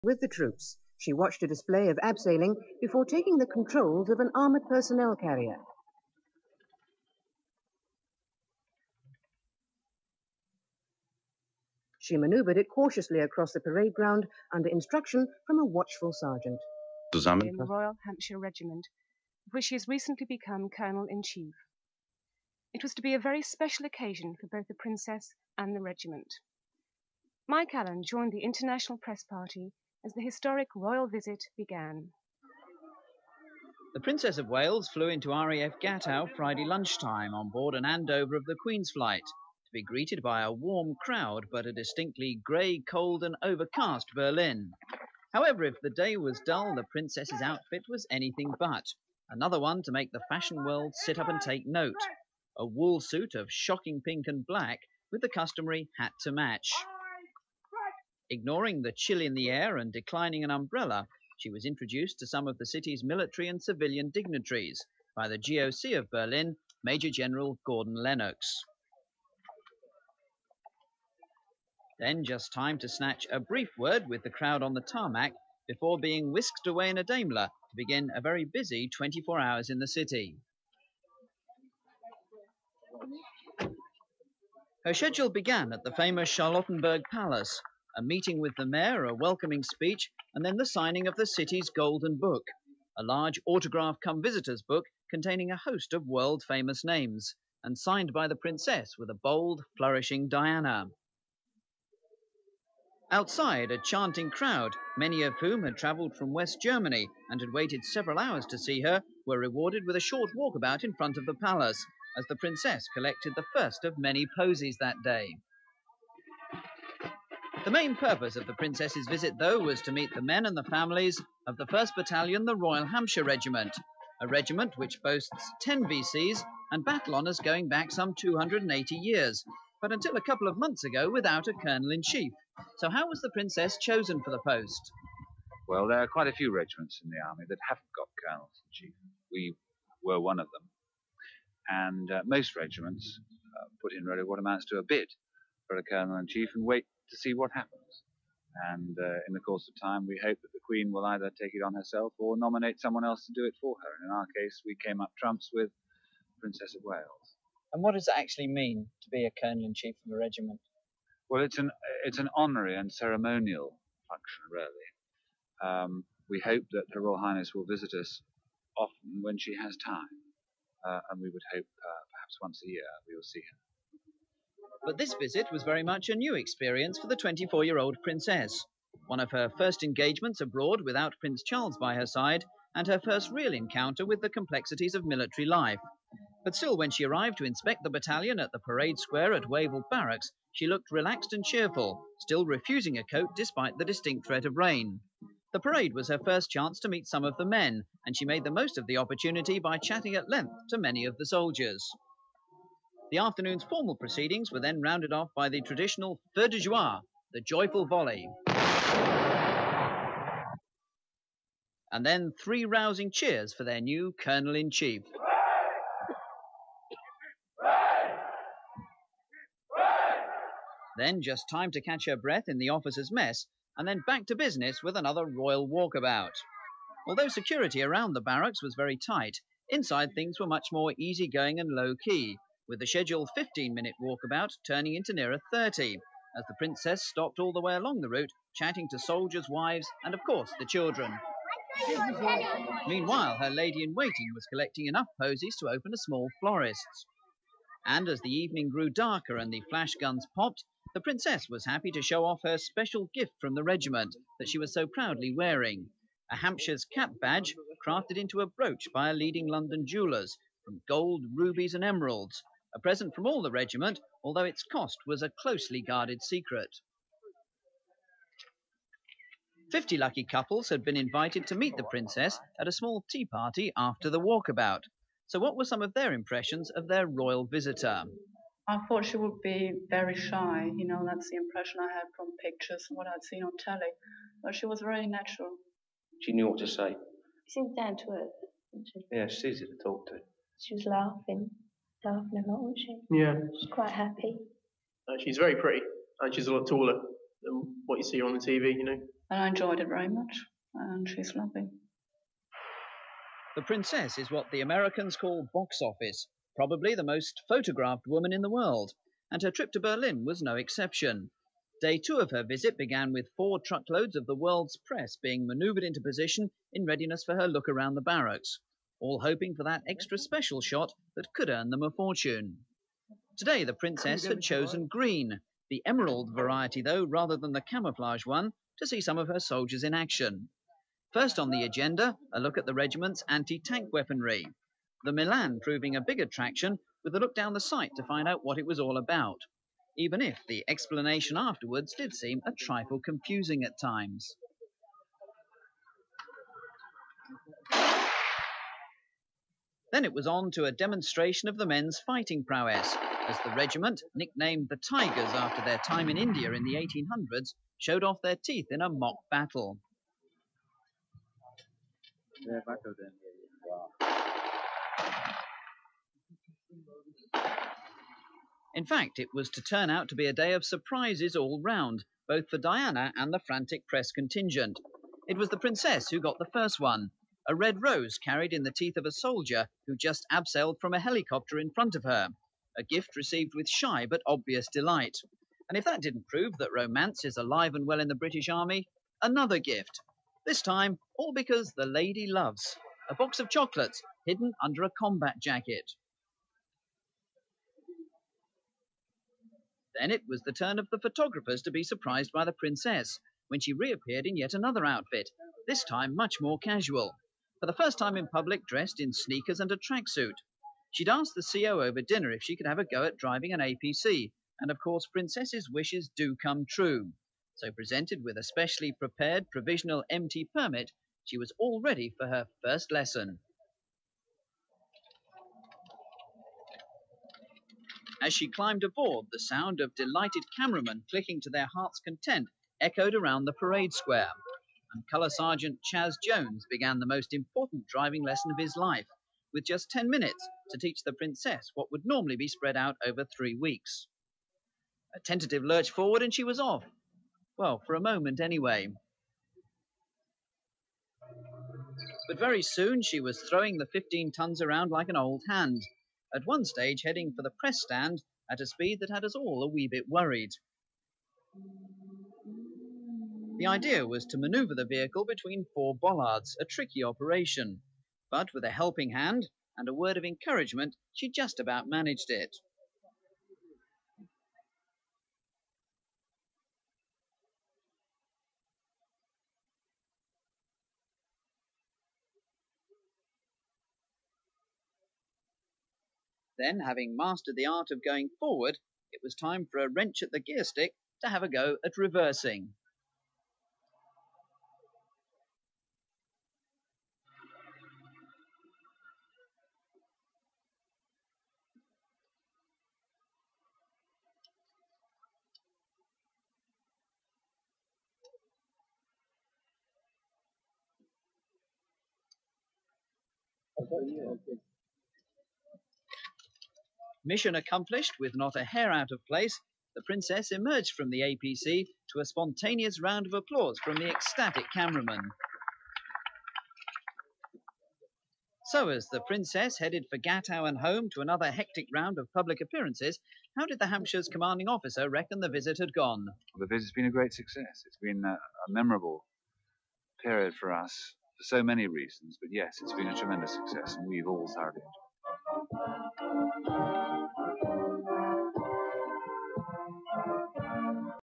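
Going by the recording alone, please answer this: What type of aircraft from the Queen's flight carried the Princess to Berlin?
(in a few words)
Andover.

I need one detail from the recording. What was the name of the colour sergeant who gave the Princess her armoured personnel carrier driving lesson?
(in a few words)
Chaz Jones.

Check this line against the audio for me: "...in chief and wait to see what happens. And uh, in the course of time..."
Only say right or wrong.
right.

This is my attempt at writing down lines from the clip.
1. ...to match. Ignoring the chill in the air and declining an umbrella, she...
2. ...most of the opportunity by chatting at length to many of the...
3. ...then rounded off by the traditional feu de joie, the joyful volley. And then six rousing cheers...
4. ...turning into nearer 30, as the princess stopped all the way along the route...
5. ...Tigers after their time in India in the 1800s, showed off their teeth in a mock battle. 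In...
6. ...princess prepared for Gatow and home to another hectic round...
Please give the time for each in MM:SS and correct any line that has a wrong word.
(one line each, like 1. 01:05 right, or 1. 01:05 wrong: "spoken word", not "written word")
1. 00:56 right
2. 03:18 right
3. 03:24 wrong: "three", not "six"
4. 03:54 right
5. 05:54 right
6. 08:49 wrong: "headed", not "prepared".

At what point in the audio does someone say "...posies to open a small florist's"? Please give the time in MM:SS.
04:05.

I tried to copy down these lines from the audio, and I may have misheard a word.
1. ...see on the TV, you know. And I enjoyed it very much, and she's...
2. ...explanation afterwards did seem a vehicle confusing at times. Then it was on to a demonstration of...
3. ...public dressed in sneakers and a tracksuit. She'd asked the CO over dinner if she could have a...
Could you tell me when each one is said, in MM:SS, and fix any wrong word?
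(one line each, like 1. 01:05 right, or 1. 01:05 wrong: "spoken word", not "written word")
1. 04:58 right
2. 05:40 wrong: "trifle", not "vehicle"
3. 06:48 right.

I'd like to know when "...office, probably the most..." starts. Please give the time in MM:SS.
05:05.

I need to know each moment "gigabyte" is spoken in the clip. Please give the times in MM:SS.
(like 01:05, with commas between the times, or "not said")
not said.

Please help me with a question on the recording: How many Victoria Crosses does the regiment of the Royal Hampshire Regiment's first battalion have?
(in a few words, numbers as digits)
10.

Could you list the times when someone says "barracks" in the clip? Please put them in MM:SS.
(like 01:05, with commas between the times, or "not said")
03:09, 03:48, 05:18.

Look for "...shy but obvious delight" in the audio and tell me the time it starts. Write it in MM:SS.
06:23.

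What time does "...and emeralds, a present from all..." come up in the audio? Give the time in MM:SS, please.
04:21.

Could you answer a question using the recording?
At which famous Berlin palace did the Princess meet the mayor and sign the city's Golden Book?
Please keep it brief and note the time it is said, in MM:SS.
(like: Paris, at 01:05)
Charlottenburg Palace, at 01:26.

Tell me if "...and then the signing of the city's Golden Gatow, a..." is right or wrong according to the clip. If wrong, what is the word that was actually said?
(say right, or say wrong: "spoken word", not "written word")
wrong: "Book", not "Gatow".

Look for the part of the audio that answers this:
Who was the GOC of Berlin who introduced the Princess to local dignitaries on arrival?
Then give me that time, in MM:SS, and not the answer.
01:06.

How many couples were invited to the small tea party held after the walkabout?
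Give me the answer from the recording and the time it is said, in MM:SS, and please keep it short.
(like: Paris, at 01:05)
50, at 04:29.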